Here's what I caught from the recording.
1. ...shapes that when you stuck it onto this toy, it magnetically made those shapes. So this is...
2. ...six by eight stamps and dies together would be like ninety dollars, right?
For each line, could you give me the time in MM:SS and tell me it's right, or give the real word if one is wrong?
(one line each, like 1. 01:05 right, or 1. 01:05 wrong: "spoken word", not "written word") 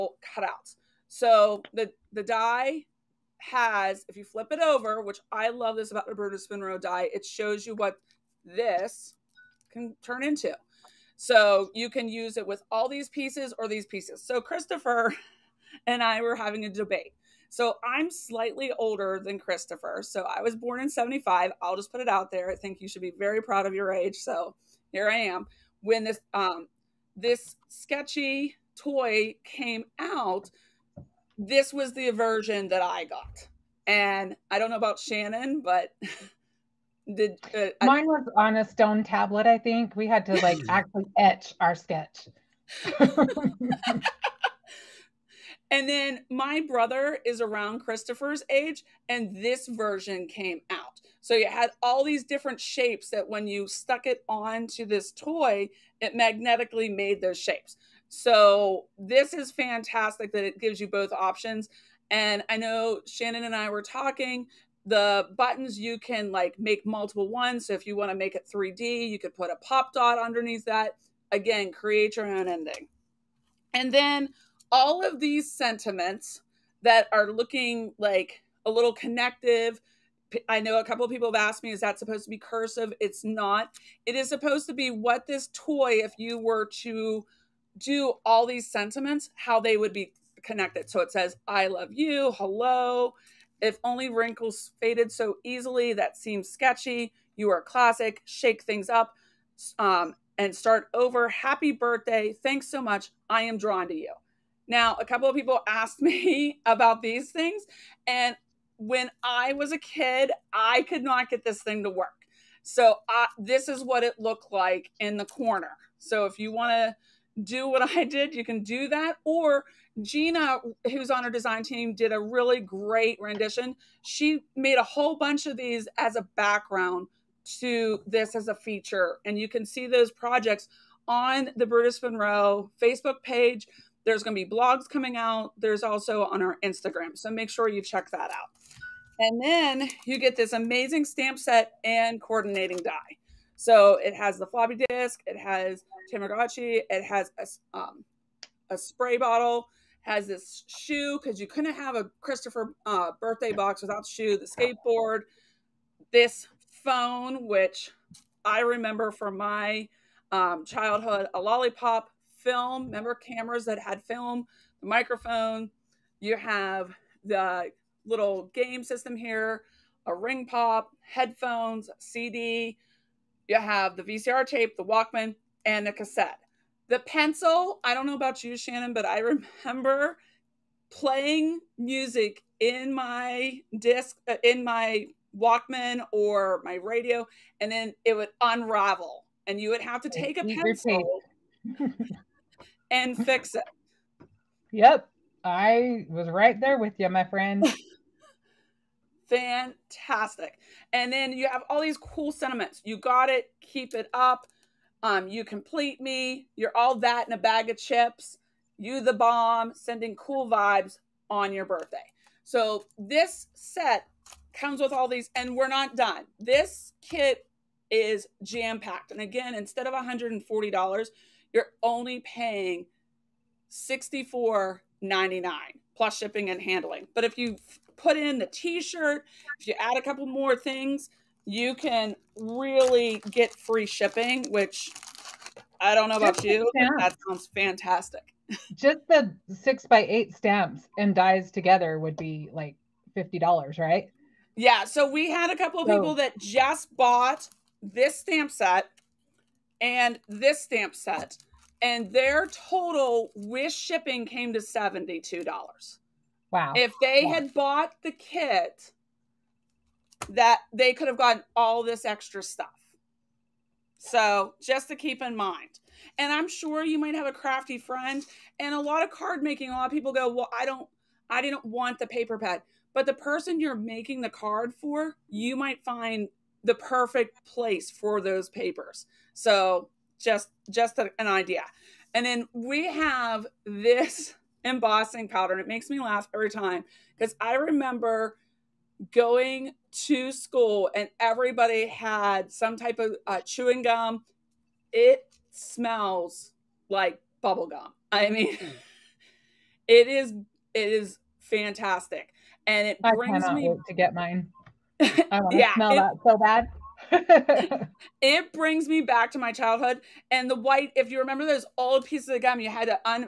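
1. 00:52 right
2. 03:59 wrong: "fifty", not "ninety".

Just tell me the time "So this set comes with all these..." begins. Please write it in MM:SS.
03:32.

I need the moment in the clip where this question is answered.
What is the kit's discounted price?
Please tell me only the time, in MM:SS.
03:43.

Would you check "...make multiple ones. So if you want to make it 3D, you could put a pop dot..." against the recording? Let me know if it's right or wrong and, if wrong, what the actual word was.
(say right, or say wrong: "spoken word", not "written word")
right.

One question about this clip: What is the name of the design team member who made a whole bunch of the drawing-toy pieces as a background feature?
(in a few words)
Gina.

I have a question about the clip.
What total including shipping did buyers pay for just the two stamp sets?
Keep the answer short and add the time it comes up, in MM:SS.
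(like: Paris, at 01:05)
$72, at 04:14.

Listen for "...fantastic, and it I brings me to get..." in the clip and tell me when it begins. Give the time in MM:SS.
05:01.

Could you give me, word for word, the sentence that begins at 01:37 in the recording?
You are classic, shake things up um, and start over.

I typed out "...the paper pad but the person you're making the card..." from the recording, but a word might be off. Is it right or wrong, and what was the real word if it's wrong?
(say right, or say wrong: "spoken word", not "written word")
right.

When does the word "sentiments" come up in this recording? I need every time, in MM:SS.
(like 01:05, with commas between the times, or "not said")
01:15, 01:28, 03:22.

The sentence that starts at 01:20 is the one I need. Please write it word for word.
I know a couple of people have asked me, is that supposed to be cursive?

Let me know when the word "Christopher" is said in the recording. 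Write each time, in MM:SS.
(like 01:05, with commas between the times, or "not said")
00:14, 00:19, 00:47, 02:32.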